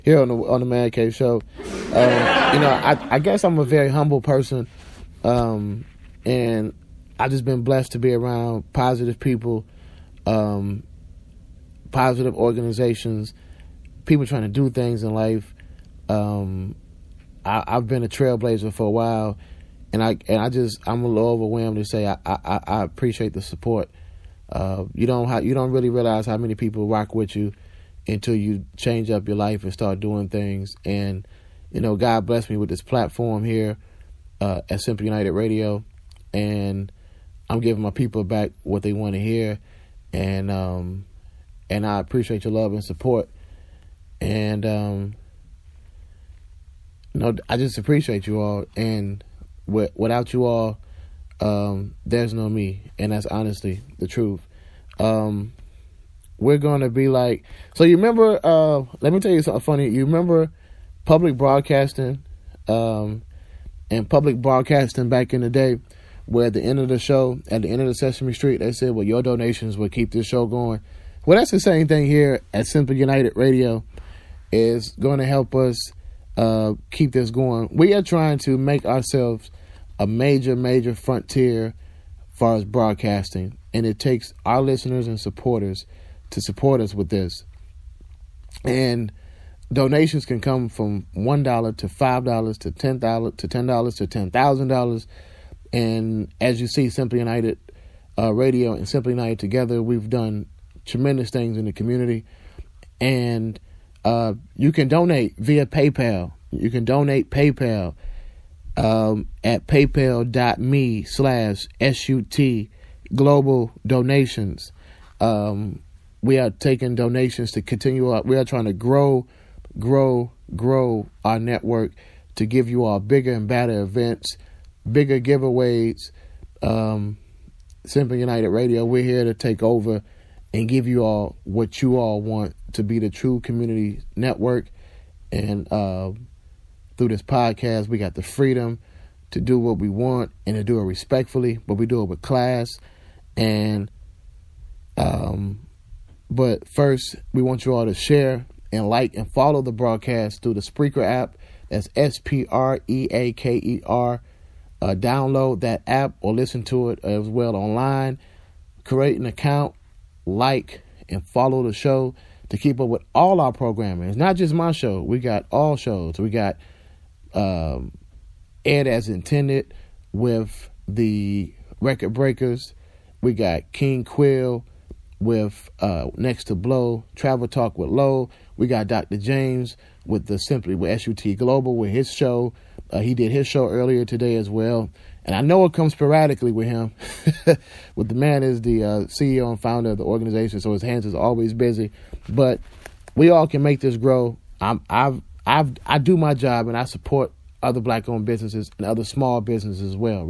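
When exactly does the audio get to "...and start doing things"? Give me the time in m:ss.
0:29.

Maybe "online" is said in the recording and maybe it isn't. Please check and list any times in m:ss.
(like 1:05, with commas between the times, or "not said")
2:37.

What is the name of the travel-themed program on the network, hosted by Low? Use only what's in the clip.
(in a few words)
Travel Talk.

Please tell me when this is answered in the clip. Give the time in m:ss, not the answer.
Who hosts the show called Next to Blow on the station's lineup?
2:53.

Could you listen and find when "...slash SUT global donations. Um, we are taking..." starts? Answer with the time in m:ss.
1:51.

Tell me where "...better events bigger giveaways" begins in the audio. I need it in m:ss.
2:03.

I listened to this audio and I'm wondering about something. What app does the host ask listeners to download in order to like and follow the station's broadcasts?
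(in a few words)
Spreaker.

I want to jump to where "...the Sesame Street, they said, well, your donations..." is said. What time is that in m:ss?
1:07.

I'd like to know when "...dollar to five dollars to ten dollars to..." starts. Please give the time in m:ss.
1:31.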